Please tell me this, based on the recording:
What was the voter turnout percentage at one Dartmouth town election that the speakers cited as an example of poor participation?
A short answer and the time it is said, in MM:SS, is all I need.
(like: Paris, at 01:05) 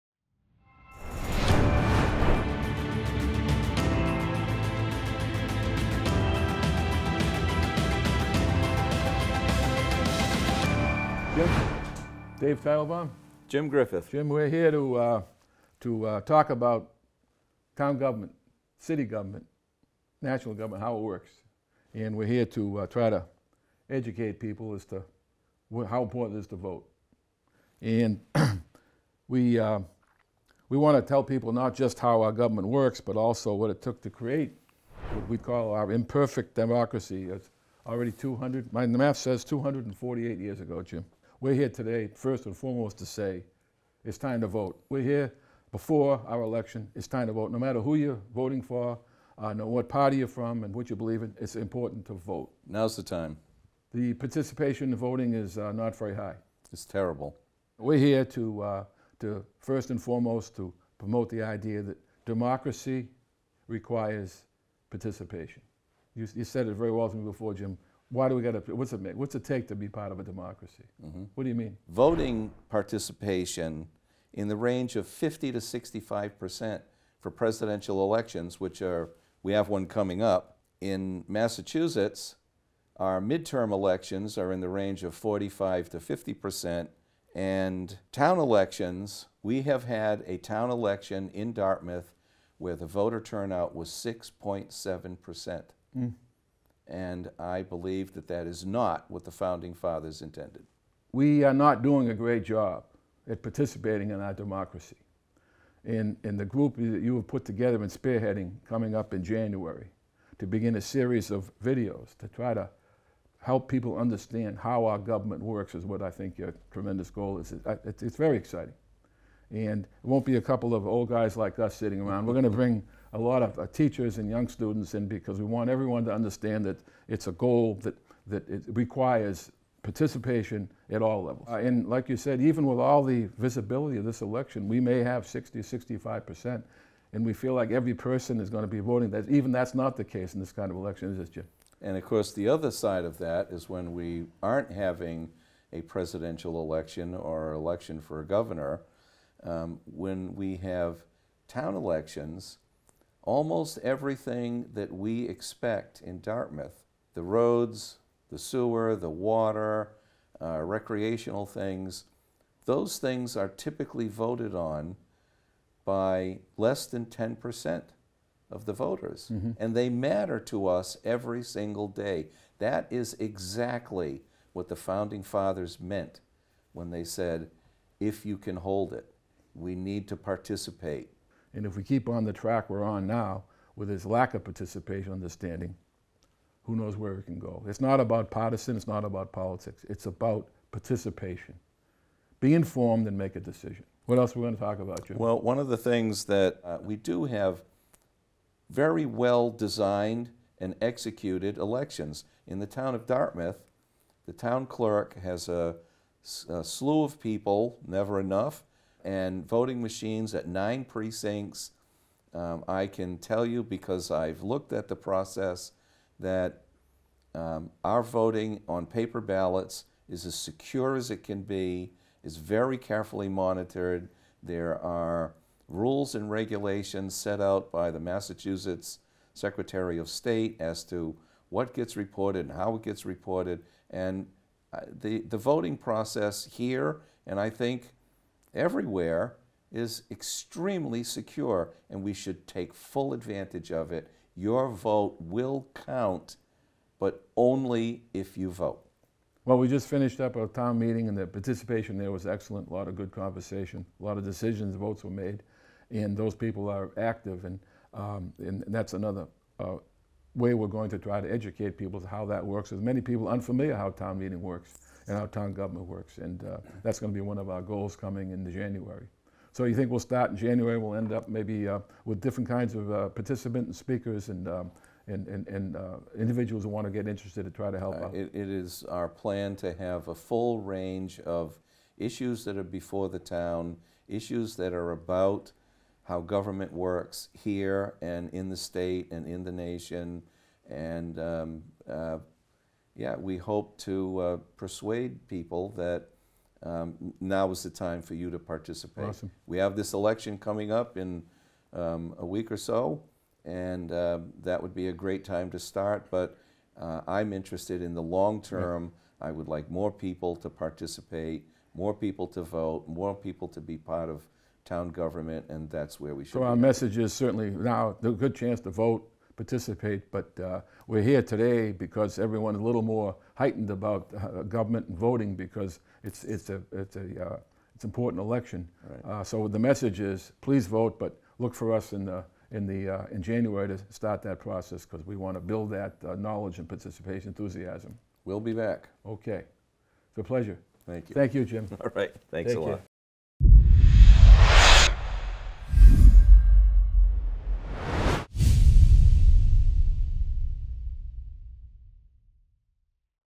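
6.7 percent, at 01:34.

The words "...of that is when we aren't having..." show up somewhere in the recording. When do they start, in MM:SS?
02:23.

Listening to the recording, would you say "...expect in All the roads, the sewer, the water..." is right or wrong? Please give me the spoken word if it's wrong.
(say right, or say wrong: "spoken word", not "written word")
wrong: "Dartmouth", not "All".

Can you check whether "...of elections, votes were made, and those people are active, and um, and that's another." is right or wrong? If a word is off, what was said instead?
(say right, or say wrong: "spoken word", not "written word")
wrong: "decisions", not "elections".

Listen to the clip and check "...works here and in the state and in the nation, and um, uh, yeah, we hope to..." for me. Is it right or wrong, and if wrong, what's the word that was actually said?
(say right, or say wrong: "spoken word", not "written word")
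right.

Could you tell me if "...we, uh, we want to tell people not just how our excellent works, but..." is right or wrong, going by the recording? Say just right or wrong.
wrong.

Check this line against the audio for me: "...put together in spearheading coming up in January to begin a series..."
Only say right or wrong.
right.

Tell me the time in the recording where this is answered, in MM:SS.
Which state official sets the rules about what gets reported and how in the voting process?
03:47.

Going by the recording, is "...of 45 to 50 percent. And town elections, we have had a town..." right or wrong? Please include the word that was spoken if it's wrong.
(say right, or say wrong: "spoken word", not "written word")
right.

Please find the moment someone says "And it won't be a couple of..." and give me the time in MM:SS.
01:59.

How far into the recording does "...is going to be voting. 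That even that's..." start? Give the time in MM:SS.
02:18.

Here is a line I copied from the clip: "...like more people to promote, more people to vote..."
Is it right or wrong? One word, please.
wrong.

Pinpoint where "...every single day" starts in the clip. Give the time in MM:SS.
02:51.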